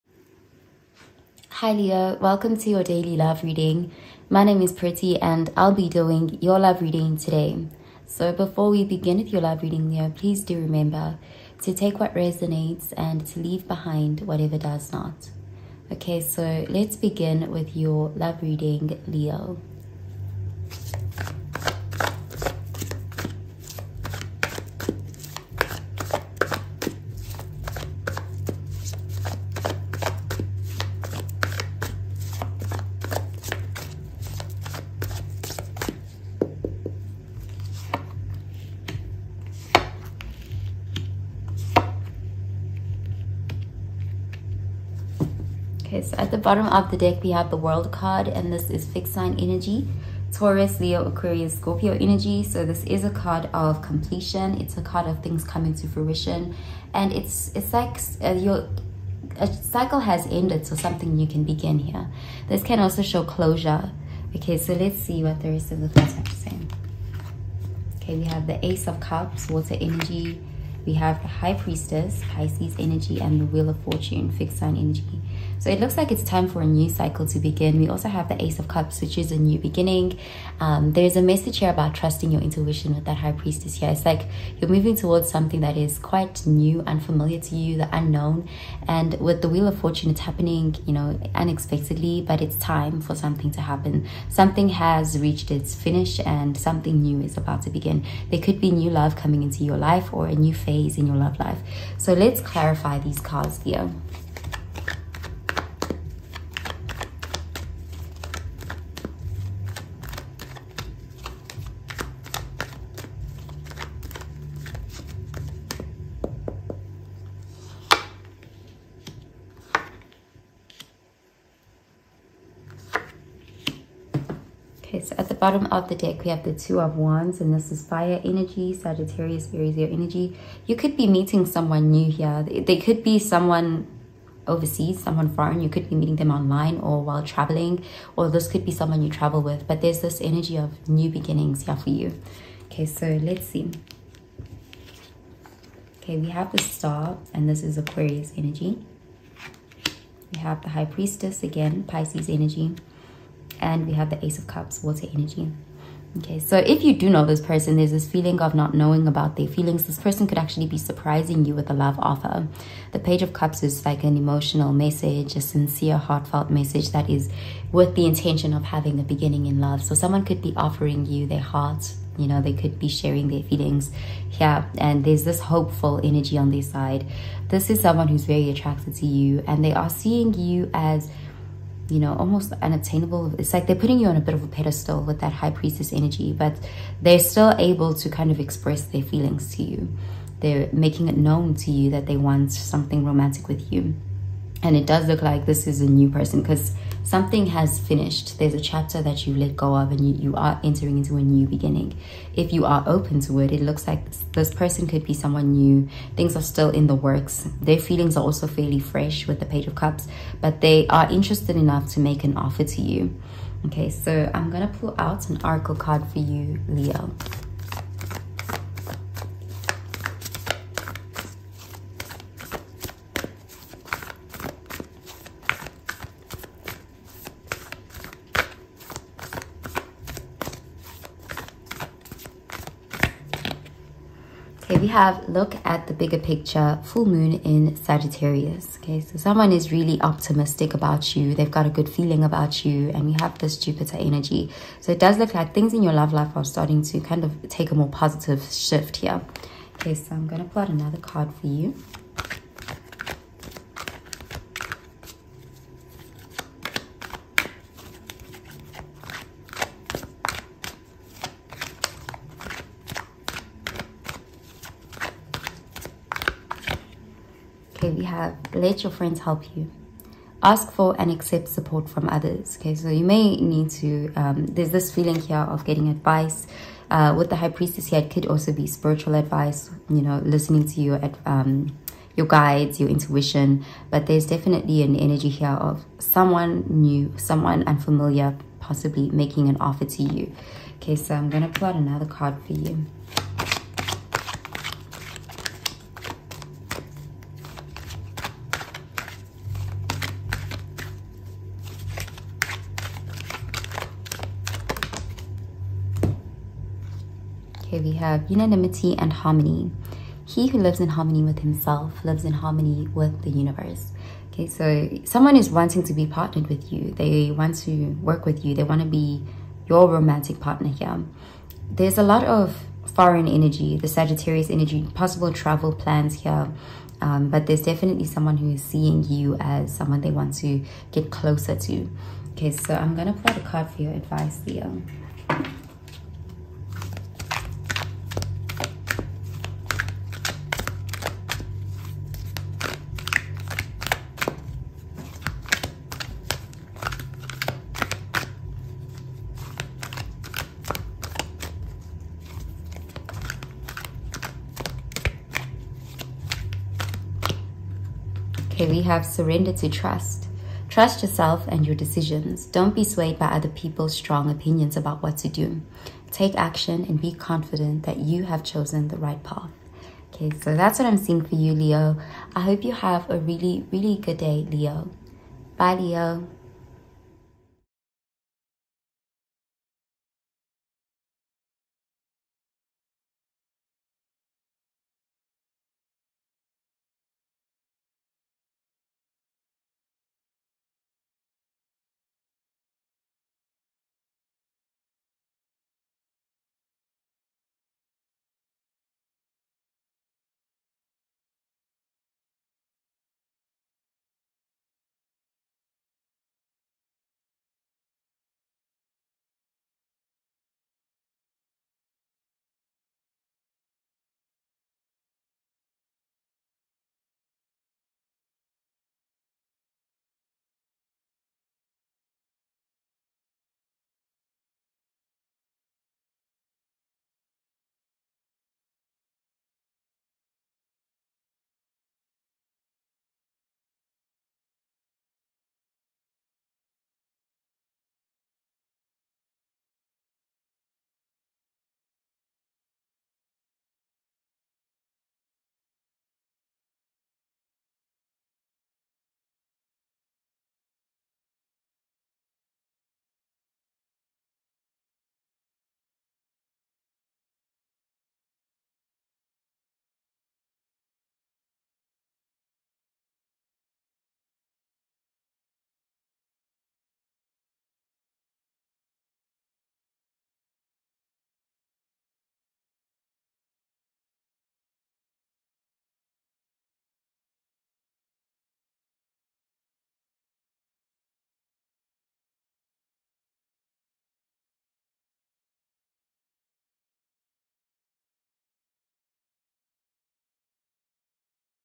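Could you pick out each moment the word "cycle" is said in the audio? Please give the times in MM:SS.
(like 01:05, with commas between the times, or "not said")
00:59, 01:16.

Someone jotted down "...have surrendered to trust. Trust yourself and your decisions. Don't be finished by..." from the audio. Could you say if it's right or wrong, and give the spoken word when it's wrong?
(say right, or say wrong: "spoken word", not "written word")
wrong: "swayed", not "finished".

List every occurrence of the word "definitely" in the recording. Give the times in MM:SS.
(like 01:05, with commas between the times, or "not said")
04:44, 05:27.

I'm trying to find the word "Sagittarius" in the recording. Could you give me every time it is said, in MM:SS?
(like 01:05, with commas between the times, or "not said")
02:08, 03:57, 05:23.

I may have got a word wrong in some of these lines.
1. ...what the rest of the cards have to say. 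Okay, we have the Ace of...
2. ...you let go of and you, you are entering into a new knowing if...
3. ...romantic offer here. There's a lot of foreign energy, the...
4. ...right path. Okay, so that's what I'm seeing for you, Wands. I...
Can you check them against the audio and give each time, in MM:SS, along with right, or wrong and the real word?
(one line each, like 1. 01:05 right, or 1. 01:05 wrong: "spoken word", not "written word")
1. 01:05 right
2. 03:19 wrong: "beginning", not "knowing"
3. 05:19 wrong: "partner", not "offer"
4. 06:08 wrong: "Leo", not "Wands".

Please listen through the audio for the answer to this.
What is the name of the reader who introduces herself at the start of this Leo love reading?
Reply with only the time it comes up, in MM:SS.
00:04.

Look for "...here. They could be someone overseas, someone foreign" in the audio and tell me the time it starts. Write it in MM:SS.
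02:12.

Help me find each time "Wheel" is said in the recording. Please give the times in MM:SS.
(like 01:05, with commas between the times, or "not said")
01:13, 01:29.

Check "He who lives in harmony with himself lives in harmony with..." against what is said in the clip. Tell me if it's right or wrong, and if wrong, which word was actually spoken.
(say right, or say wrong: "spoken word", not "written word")
right.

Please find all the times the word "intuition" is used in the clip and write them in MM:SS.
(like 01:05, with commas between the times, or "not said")
01:22, 04:42.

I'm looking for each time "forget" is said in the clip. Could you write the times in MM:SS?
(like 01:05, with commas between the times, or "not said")
not said.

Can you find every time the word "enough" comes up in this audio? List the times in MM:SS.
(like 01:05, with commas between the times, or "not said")
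03:31.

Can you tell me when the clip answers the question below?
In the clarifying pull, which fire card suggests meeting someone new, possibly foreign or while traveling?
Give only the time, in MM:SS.
02:06.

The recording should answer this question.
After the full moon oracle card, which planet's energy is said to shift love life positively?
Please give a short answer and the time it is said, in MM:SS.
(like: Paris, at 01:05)
Jupiter, at 04:03.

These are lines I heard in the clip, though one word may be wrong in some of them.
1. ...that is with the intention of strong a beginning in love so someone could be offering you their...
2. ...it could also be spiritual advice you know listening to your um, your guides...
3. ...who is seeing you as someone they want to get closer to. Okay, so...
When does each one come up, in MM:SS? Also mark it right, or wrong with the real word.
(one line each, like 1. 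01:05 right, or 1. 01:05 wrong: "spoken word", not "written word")
1. 02:46 wrong: "having", not "strong"
2. 04:38 right
3. 05:28 right.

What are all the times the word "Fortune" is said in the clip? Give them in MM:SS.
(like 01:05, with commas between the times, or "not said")
01:13, 01:29.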